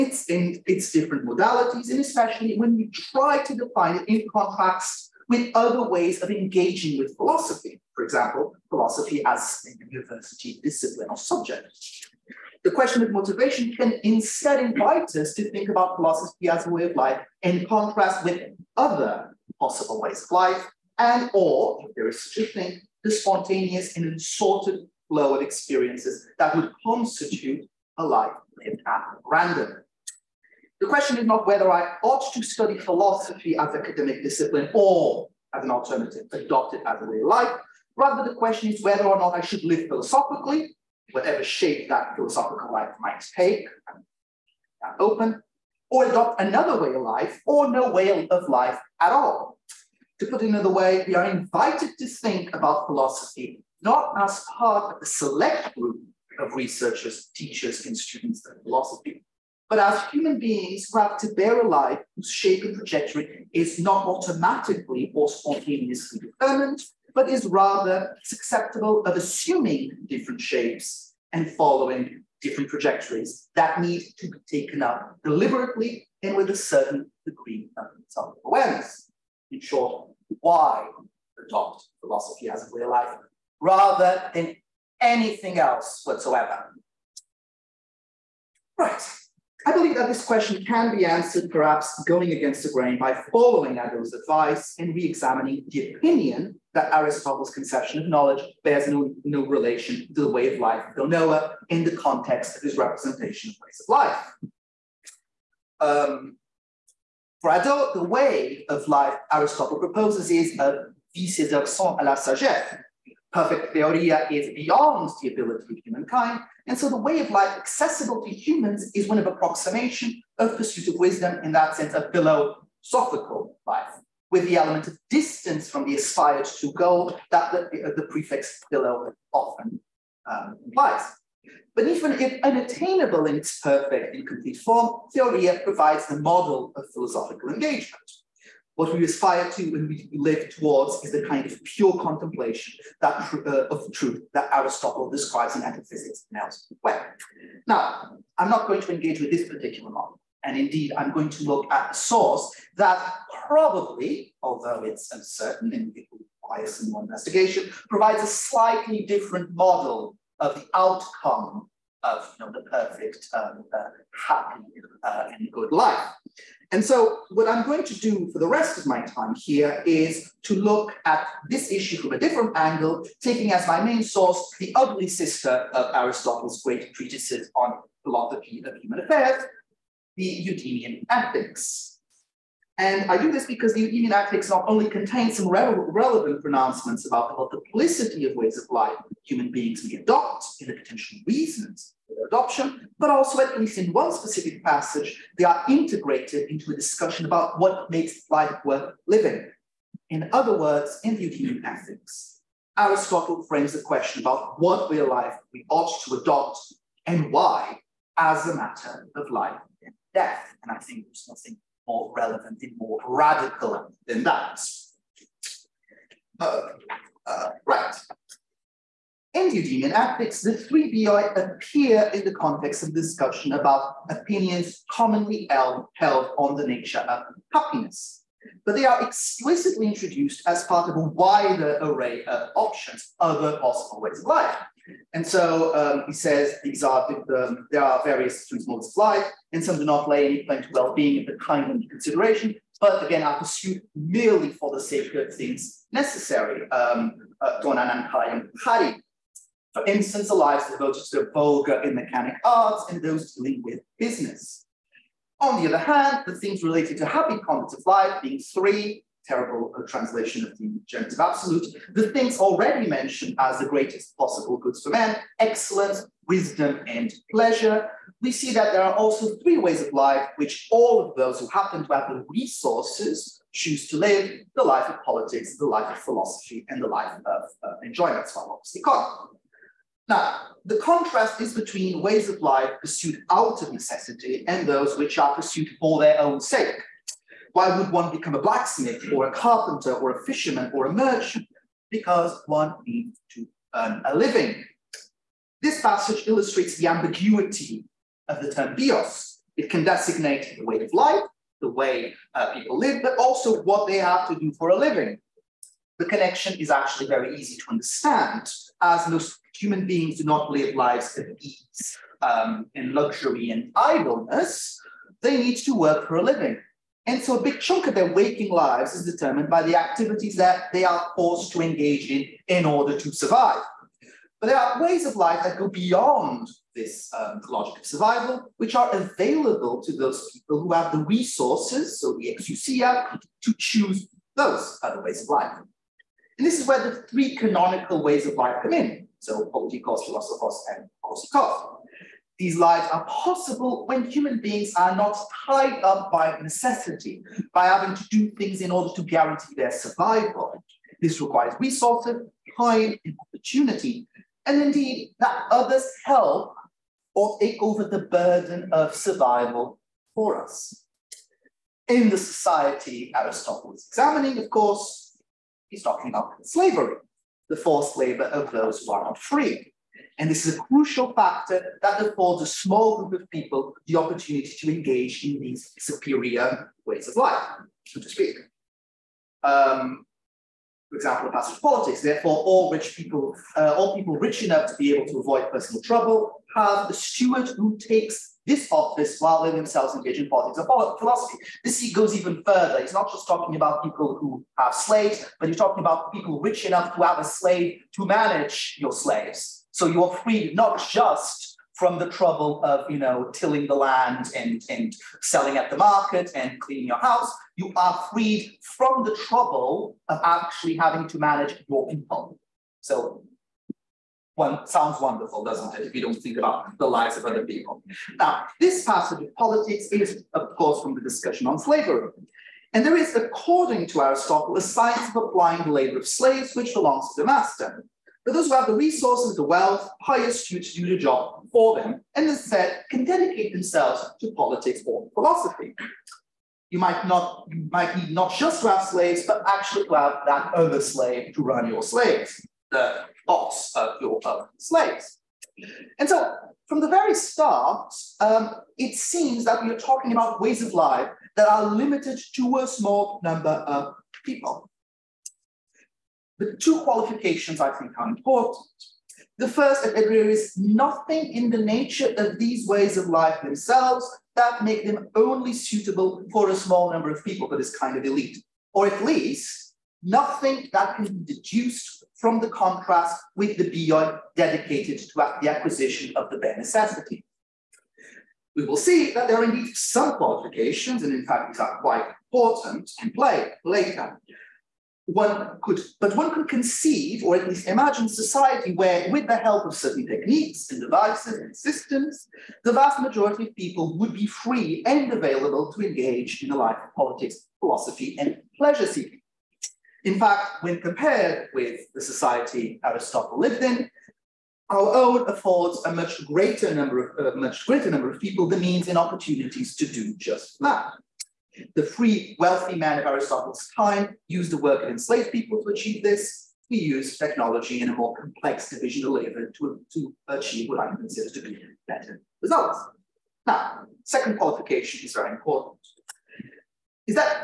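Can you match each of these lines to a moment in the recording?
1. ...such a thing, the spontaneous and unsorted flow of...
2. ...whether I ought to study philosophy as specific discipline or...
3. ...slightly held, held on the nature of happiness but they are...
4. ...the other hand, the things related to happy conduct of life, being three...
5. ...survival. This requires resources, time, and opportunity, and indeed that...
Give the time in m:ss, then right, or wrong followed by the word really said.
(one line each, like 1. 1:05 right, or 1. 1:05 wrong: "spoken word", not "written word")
1. 0:22 right
2. 0:31 wrong: "academic", not "specific"
3. 3:44 wrong: "commonly", not "slightly"
4. 4:15 right
5. 5:49 right.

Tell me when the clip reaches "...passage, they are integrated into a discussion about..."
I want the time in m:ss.
3:14.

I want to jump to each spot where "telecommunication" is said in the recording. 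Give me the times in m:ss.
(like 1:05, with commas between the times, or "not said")
not said.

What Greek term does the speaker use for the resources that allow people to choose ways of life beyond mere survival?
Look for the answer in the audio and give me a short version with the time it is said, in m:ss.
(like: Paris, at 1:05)
exousia, at 5:32.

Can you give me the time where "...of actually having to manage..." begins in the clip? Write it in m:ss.
6:50.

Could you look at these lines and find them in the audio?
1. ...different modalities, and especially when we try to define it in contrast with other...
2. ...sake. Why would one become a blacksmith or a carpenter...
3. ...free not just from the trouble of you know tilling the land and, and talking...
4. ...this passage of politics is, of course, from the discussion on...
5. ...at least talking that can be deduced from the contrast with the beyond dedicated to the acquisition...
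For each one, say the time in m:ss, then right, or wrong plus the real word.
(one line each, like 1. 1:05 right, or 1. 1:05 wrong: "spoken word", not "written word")
1. 0:00 right
2. 4:46 right
3. 6:40 wrong: "selling", not "talking"
4. 6:58 right
5. 7:48 wrong: "nothing", not "talking".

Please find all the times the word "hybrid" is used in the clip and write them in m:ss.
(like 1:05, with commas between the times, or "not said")
not said.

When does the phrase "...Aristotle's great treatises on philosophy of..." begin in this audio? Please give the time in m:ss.
2:55.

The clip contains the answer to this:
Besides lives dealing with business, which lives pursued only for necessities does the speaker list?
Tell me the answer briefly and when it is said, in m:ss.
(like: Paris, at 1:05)
vulgar and mechanic arts, at 4:11.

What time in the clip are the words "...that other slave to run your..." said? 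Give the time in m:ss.
7:20.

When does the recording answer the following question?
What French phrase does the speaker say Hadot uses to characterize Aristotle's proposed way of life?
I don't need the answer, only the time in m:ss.
1:51.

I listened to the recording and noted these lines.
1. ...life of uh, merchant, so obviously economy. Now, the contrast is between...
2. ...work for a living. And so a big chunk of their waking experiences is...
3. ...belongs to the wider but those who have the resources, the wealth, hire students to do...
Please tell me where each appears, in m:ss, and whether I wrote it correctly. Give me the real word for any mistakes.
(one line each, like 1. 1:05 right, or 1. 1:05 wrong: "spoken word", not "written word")
1. 4:36 wrong: "enjoyment", not "merchant"
2. 5:15 wrong: "lives", not "experiences"
3. 7:06 wrong: "master", not "wider".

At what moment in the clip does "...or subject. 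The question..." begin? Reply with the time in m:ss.
0:11.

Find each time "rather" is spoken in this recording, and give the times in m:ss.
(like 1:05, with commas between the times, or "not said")
0:37, 1:07, 1:23.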